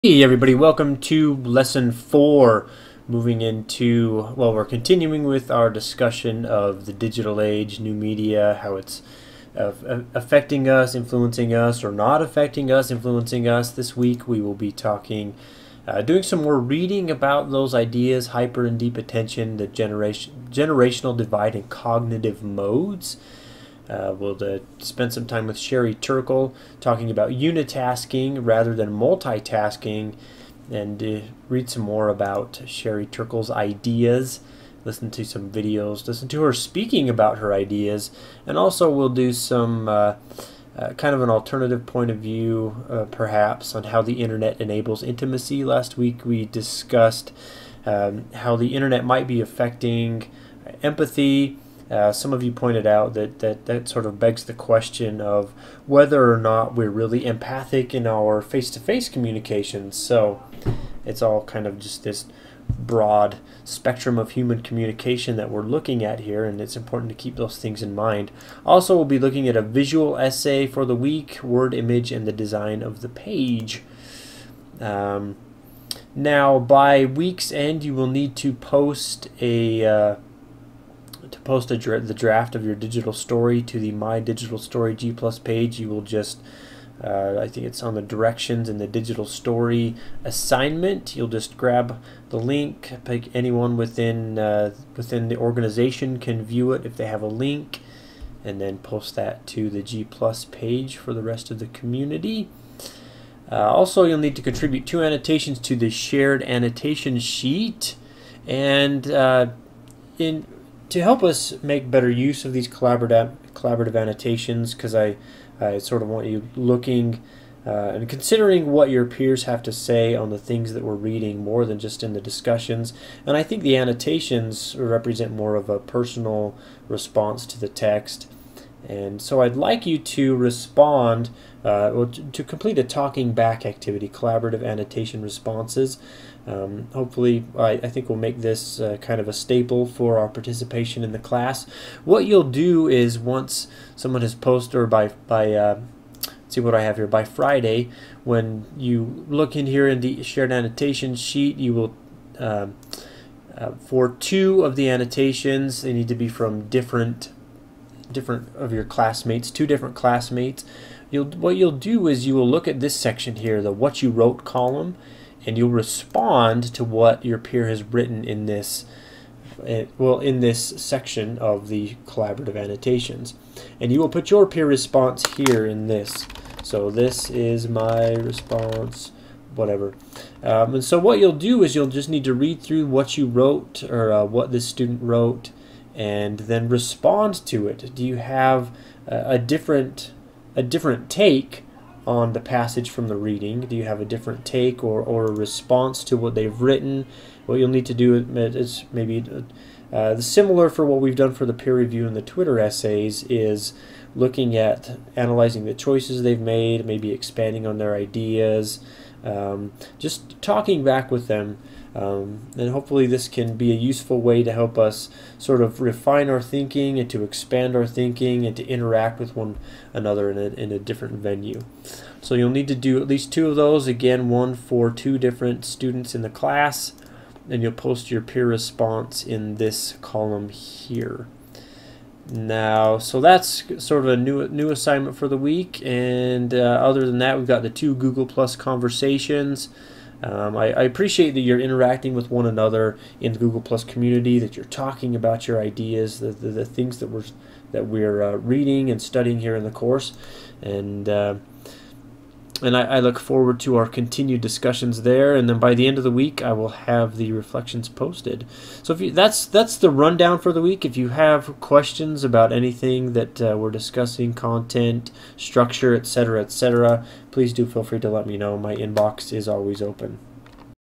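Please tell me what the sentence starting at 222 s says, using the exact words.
So, you'll need to do at least two of those.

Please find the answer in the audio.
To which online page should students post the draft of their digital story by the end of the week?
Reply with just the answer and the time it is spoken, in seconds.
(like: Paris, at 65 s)
My Digital Story G Plus page, at 83 s.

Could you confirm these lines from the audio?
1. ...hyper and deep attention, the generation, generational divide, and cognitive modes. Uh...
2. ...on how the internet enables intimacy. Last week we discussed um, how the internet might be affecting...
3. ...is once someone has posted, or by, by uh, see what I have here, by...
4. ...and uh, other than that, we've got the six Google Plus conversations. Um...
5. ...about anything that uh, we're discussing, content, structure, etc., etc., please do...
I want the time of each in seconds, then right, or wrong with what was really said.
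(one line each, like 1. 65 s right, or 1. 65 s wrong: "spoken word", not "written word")
1. 18 s right
2. 43 s right
3. 142 s right
4. 235 s wrong: "two", not "six"
5. 262 s right.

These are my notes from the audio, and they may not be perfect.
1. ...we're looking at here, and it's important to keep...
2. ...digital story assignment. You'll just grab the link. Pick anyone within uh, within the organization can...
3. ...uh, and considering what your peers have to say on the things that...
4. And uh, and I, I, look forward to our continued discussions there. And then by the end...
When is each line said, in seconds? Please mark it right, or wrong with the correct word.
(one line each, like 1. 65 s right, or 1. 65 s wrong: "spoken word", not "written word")
1. 65 s right
2. 88 s right
3. 117 s right
4. 250 s right.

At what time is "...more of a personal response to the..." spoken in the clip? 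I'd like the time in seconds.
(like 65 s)
125 s.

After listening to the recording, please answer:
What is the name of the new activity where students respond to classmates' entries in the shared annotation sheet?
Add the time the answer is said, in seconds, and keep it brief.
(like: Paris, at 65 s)
talking back activity, at 132 s.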